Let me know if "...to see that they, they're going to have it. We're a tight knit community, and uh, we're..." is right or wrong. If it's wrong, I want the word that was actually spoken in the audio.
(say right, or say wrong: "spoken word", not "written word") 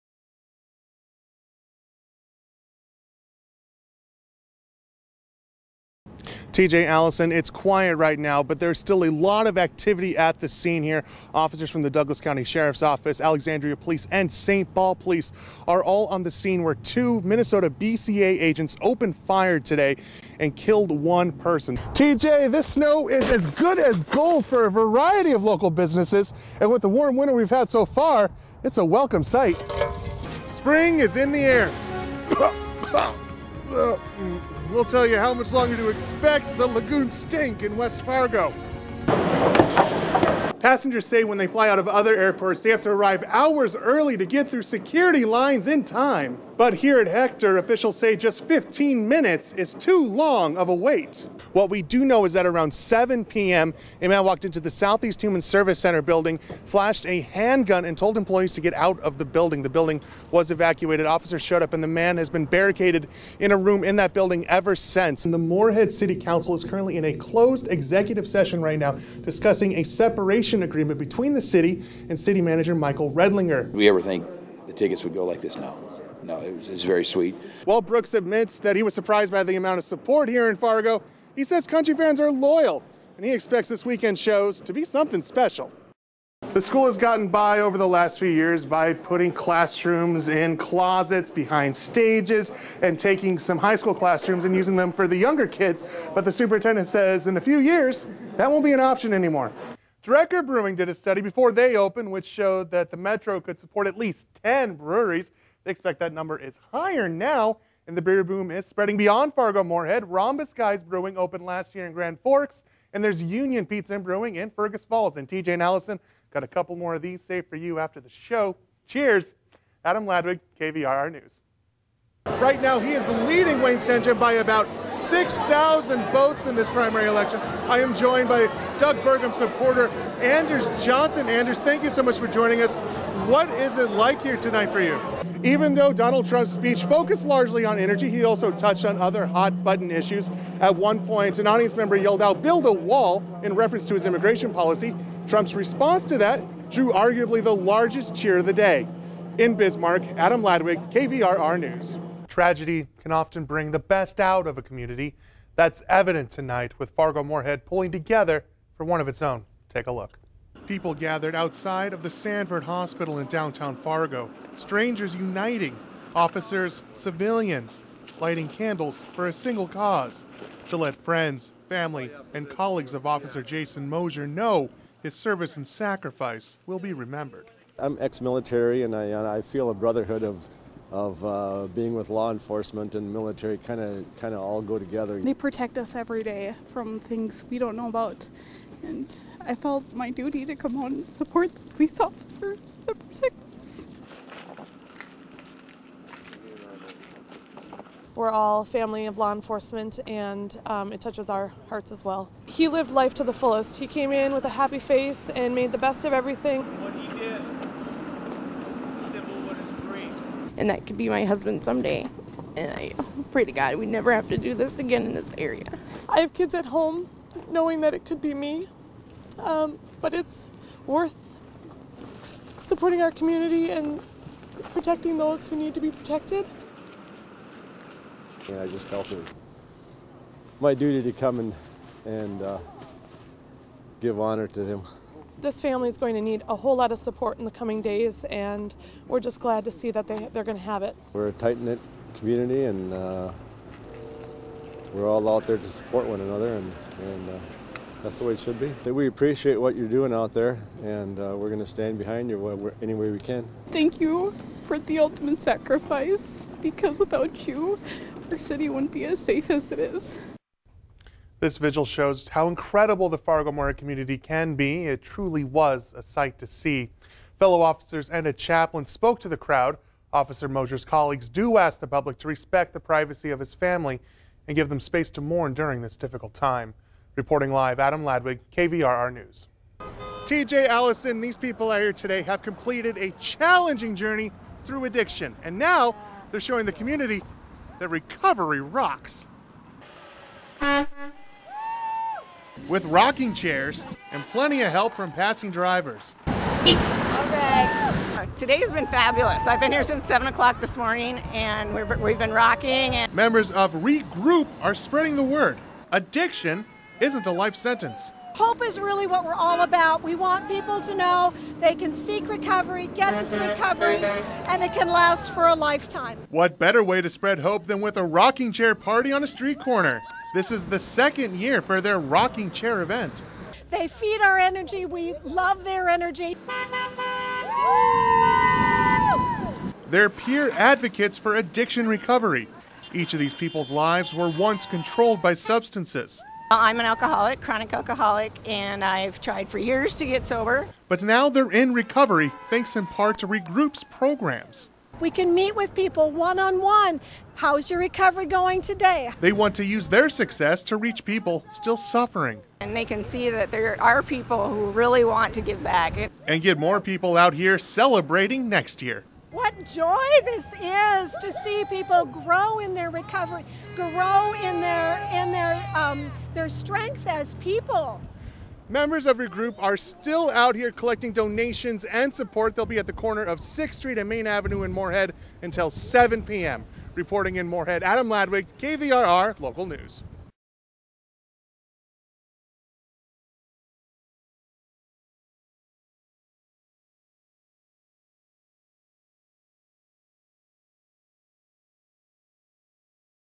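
right.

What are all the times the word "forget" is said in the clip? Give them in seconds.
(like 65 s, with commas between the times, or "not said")
not said.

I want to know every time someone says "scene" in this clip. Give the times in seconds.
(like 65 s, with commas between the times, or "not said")
10 s, 16 s.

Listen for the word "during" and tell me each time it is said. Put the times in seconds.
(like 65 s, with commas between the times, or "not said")
275 s.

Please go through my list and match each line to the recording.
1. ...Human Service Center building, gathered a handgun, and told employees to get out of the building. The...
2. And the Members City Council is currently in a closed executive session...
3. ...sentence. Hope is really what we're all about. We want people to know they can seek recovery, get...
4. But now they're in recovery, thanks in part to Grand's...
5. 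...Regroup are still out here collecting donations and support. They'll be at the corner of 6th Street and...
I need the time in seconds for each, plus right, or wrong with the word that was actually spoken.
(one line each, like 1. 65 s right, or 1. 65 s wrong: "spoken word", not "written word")
1. 55 s wrong: "flashed", not "gathered"
2. 65 s wrong: "Moorhead", not "Members"
3. 307 s right
4. 340 s wrong: "Regroup", not "Grand"
5. 369 s right.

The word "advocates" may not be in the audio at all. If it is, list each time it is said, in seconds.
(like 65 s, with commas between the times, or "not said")
330 s.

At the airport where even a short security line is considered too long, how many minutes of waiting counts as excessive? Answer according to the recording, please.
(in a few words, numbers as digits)
15 minutes.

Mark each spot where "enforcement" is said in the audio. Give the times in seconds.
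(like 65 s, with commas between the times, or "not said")
182 s, 199 s.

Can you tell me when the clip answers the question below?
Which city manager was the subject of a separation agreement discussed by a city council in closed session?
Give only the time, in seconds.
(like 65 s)
72 s.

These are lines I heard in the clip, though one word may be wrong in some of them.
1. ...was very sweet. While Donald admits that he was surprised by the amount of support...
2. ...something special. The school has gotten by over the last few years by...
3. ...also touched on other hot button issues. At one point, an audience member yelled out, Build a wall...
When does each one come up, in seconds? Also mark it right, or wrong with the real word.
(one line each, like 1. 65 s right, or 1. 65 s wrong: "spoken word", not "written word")
1. 76 s wrong: "Brooks", not "Donald"
2. 84 s right
3. 138 s right.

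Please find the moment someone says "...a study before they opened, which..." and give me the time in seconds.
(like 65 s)
100 s.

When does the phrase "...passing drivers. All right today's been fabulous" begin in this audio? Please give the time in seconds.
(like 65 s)
295 s.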